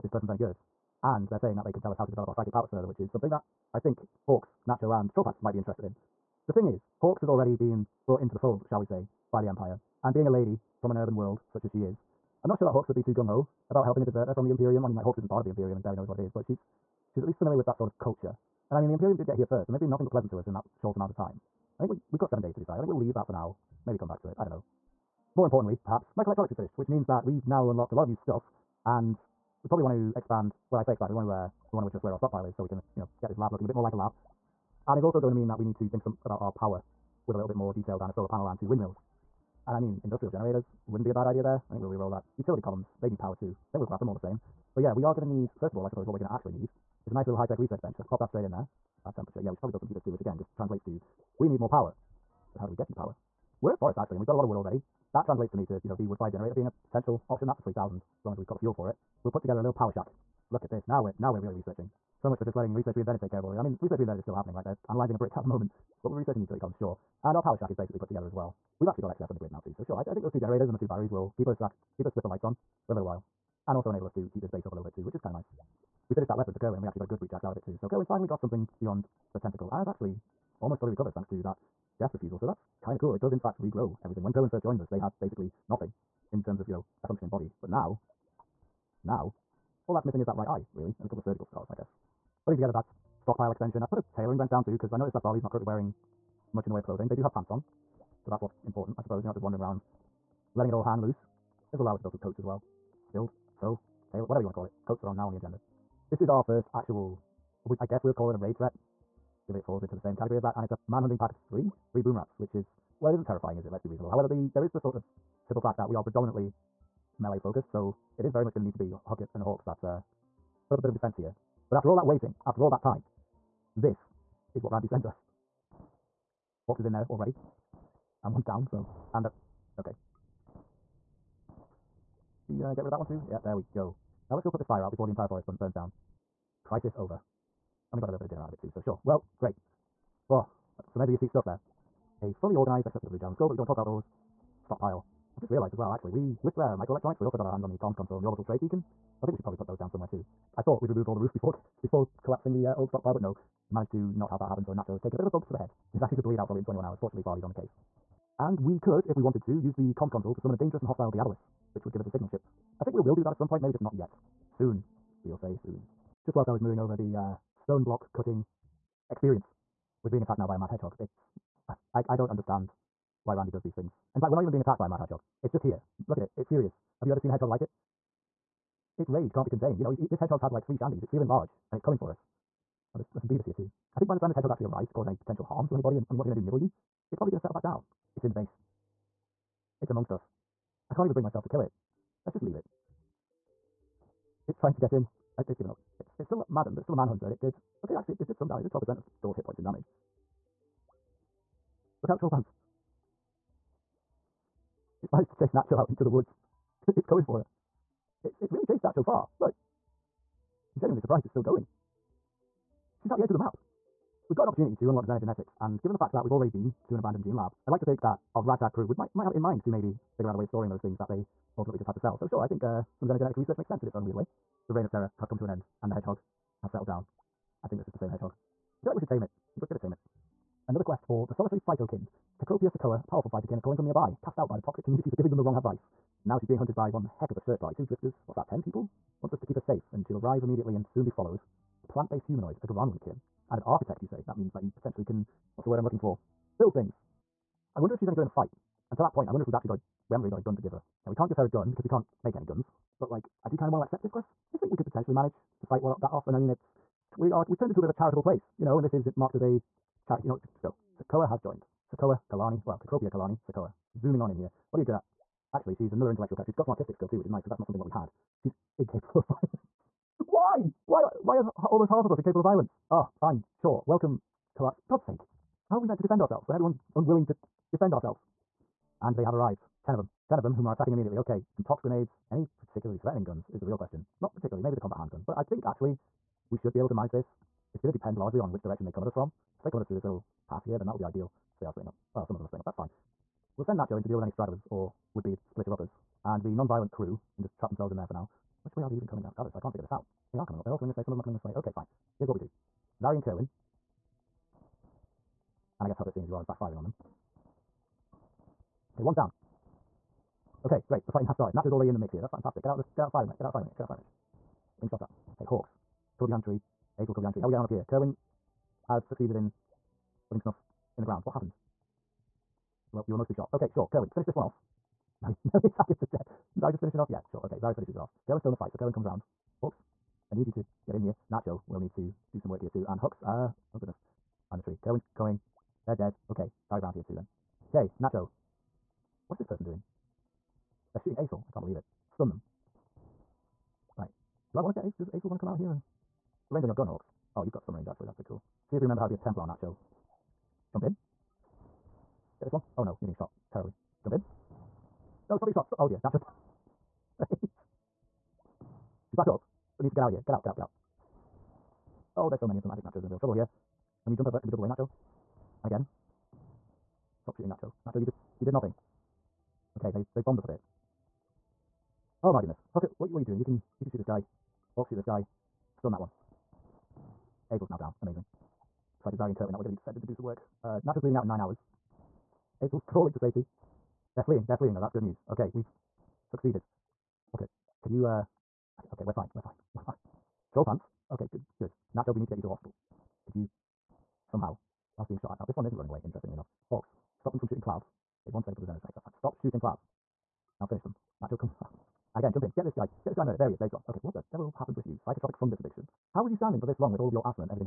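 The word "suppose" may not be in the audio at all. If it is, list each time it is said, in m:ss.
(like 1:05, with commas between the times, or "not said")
0:45, 1:39.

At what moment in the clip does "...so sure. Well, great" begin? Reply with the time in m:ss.
2:18.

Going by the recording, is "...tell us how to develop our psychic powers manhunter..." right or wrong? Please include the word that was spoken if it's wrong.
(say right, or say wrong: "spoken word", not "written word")
wrong: "further", not "manhunter".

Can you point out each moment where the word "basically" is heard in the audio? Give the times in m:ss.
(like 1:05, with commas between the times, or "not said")
1:07, 1:25.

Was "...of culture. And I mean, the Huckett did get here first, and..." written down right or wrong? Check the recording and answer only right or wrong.
wrong.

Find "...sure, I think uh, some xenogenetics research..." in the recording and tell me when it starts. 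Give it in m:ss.
3:42.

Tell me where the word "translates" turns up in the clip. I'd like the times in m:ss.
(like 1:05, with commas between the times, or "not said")
0:50, 0:55.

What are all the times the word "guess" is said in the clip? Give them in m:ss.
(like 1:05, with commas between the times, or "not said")
1:31, 1:47, 5:05.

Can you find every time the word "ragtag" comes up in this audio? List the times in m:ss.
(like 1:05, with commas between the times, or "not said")
3:38.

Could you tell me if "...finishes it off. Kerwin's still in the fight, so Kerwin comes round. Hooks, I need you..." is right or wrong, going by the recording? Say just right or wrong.
right.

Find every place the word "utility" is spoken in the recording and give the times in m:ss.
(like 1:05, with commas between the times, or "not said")
0:42, 1:06.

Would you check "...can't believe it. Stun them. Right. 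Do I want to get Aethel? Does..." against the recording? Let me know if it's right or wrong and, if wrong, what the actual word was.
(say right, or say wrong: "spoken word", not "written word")
right.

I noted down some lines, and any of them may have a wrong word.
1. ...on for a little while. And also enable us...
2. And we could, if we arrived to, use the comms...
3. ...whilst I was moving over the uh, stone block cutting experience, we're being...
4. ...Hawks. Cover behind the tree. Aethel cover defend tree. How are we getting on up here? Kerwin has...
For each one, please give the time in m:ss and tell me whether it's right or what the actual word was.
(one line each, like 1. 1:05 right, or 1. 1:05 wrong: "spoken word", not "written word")
1. 1:12 right
2. 2:38 wrong: "wanted", not "arrived"
3. 2:46 right
4. 5:15 wrong: "behind", not "defend".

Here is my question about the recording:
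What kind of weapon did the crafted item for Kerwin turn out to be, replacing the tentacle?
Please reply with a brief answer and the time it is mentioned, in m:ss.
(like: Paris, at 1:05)
breach axe, at 1:17.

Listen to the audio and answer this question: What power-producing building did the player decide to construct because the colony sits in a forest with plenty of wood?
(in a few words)
wood fire generator.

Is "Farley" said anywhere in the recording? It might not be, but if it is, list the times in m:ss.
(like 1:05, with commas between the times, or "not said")
1:35, 2:37.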